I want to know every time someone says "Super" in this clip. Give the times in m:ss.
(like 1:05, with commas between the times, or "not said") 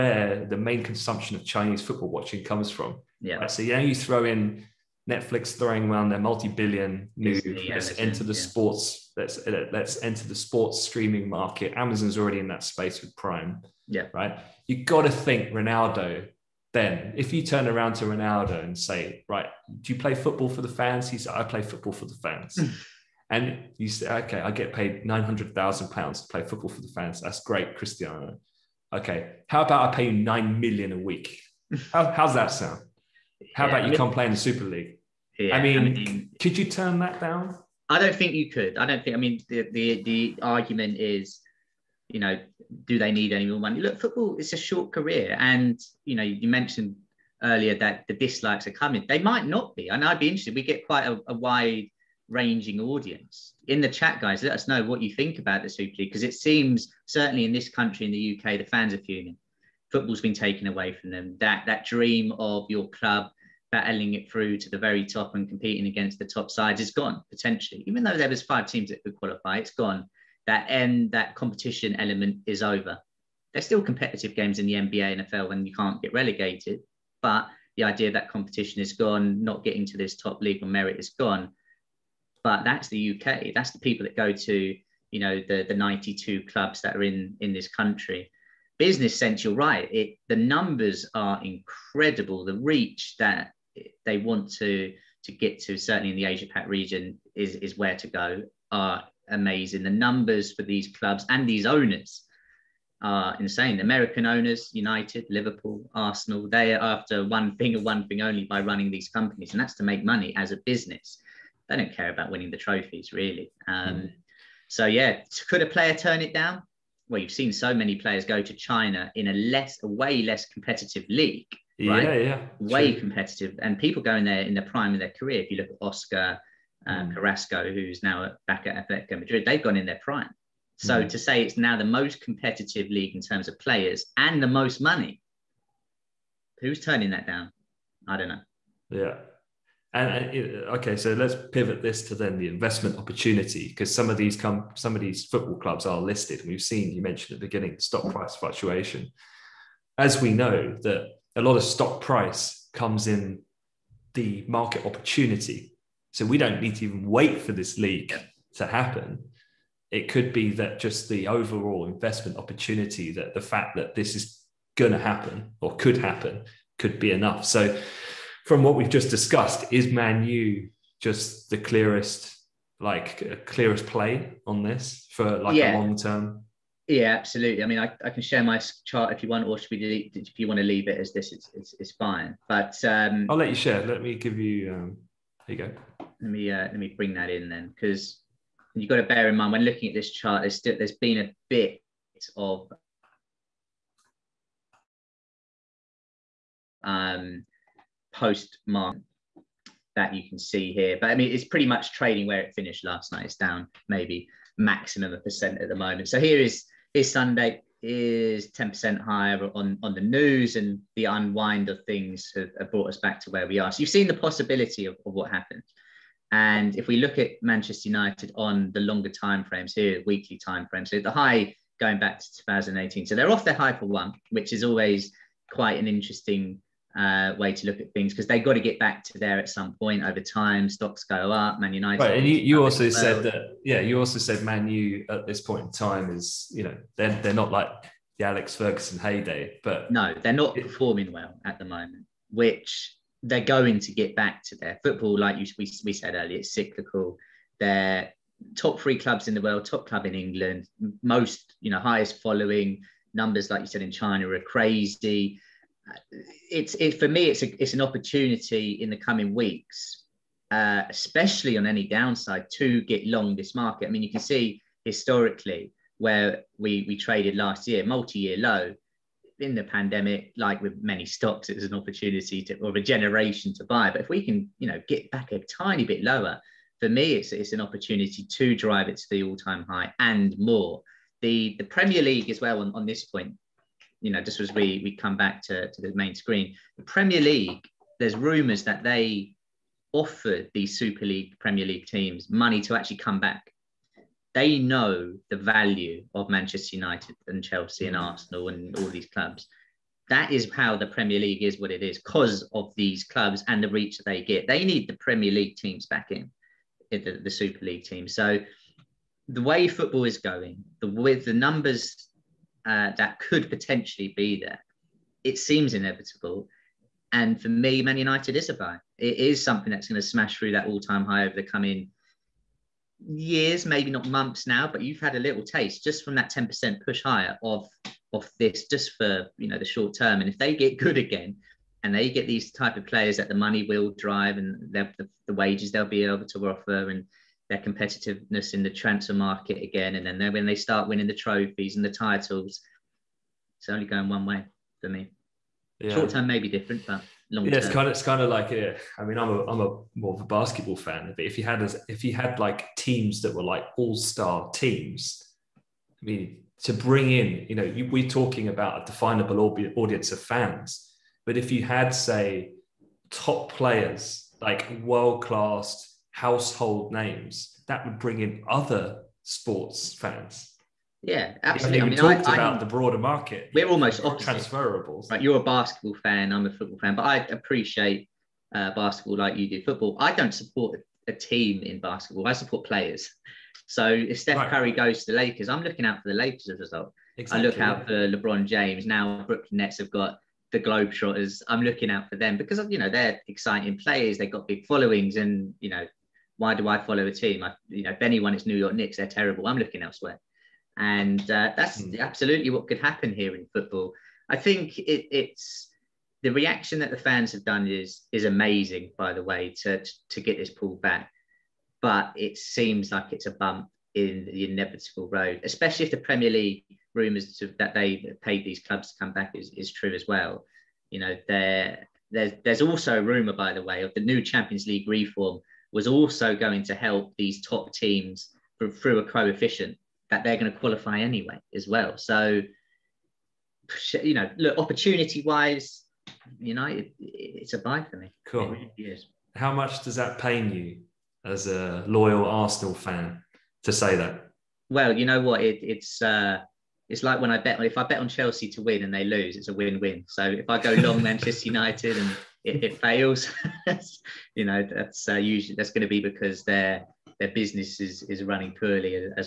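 0:34, 0:55, 4:50, 5:07.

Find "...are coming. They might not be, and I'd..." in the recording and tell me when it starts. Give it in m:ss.
0:48.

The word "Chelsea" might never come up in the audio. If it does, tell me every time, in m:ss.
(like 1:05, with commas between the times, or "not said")
4:57, 7:28.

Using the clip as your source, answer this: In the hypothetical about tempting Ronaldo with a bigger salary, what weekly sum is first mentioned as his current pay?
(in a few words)
900,000 pounds.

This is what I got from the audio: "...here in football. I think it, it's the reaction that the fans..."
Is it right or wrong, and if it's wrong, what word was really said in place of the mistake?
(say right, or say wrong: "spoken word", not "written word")
right.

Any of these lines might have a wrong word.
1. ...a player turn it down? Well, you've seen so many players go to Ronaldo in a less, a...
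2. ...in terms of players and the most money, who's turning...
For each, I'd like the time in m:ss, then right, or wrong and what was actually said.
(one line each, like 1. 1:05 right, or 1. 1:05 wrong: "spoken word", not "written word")
1. 1:55 wrong: "China", not "Ronaldo"
2. 2:13 right.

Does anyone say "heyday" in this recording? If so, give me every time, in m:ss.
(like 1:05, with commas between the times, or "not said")
3:58.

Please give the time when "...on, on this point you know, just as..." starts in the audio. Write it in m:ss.
4:42.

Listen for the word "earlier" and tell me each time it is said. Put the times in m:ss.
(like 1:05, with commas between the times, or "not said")
0:47, 4:06.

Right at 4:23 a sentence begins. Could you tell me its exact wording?
I mean, you can see historically where we we traded last year, multi-year low in the pandemic.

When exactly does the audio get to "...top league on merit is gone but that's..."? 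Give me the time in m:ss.
1:20.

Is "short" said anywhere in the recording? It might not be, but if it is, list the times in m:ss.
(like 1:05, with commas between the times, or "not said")
0:44, 5:29, 5:45.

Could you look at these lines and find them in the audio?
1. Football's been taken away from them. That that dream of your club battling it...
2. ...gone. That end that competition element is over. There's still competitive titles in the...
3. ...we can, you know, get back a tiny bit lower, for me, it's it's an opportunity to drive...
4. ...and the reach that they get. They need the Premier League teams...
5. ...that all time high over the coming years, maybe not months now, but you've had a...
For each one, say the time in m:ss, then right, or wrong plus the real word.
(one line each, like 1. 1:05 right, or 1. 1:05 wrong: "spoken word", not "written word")
1. 0:59 right
2. 1:09 wrong: "games", not "titles"
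3. 4:34 right
4. 5:03 right
5. 5:20 right.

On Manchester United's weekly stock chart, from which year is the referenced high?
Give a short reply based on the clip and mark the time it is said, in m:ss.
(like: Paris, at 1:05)
2018, at 3:42.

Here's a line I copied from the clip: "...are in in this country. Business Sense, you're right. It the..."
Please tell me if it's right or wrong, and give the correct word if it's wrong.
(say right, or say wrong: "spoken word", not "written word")
right.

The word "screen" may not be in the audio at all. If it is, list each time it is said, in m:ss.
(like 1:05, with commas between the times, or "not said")
4:46.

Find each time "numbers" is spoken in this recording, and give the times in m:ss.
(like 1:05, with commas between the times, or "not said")
1:30, 1:40, 4:13, 5:11.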